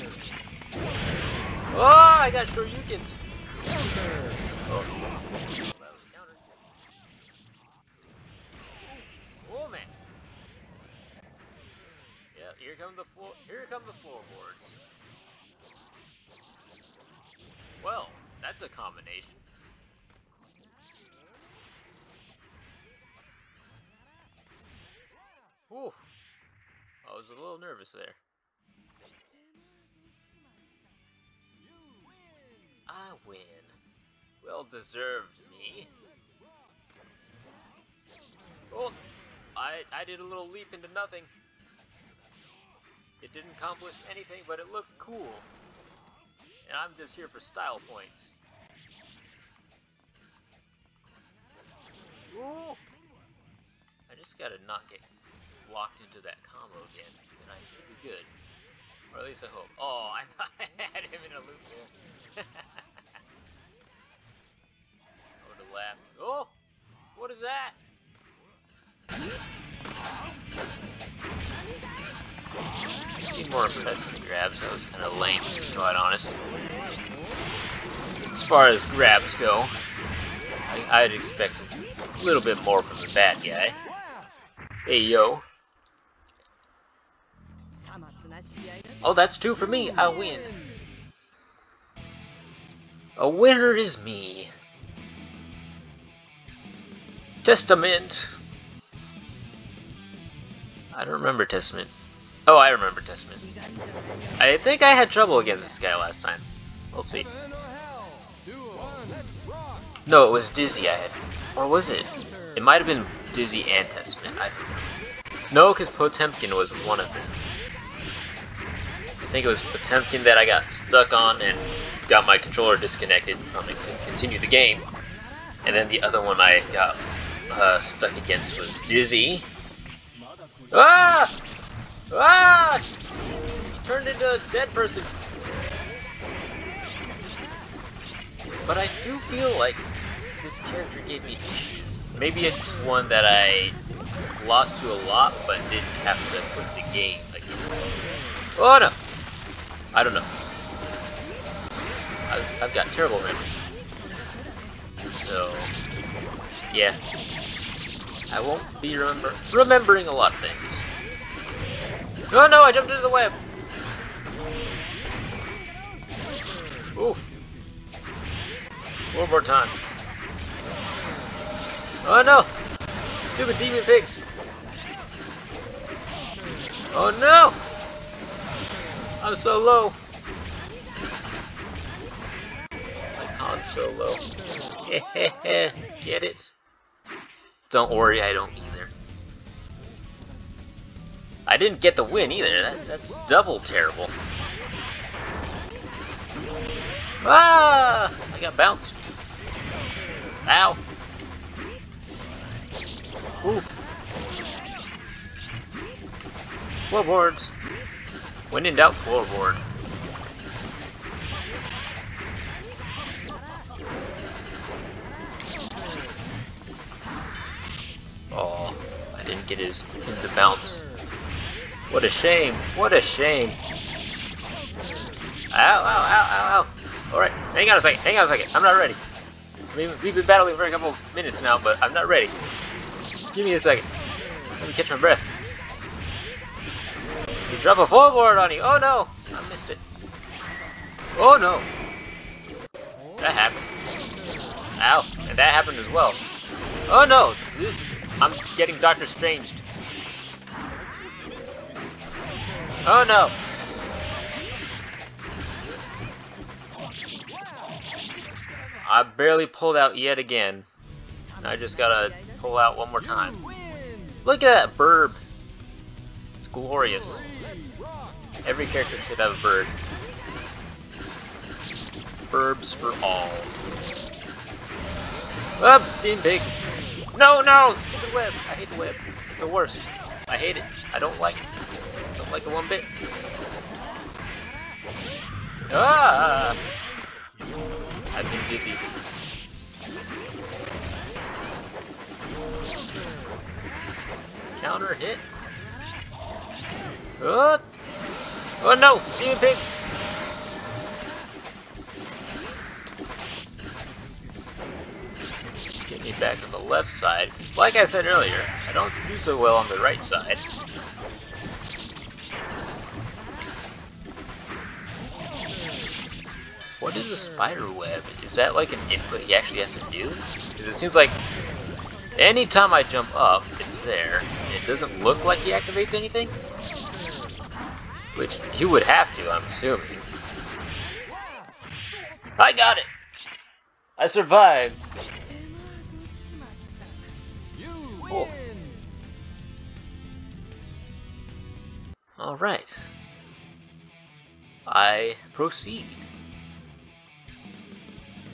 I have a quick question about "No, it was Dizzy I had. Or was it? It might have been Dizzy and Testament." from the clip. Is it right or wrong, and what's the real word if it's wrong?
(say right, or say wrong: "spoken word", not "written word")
right.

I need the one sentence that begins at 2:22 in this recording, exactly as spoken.
Maybe it's one that I lost to a lot, but didn't have to quit the game.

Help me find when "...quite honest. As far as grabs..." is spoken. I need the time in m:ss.
1:15.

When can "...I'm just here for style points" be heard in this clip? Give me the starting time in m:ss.
0:46.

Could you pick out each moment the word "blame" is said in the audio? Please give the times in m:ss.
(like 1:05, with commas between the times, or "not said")
not said.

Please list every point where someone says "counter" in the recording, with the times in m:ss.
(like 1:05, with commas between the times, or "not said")
0:06, 4:54.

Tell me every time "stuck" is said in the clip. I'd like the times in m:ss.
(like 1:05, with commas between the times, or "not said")
2:00, 2:07.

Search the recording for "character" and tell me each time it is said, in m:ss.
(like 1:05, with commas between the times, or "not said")
2:20, 4:28.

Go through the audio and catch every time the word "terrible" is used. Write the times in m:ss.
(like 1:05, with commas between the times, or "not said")
2:32, 3:13.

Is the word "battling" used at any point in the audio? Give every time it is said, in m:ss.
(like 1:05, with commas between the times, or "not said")
3:50.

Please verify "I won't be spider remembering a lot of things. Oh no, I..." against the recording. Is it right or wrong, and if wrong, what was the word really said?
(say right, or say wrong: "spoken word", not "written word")
wrong: "remember", not "spider".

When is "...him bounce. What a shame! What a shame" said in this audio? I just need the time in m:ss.
3:39.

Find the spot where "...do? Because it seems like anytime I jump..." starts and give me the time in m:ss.
5:19.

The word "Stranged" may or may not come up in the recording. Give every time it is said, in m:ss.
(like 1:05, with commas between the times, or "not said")
4:09.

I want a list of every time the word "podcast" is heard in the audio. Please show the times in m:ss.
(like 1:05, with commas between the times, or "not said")
not said.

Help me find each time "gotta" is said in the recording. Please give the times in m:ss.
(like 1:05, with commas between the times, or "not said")
0:54, 4:21.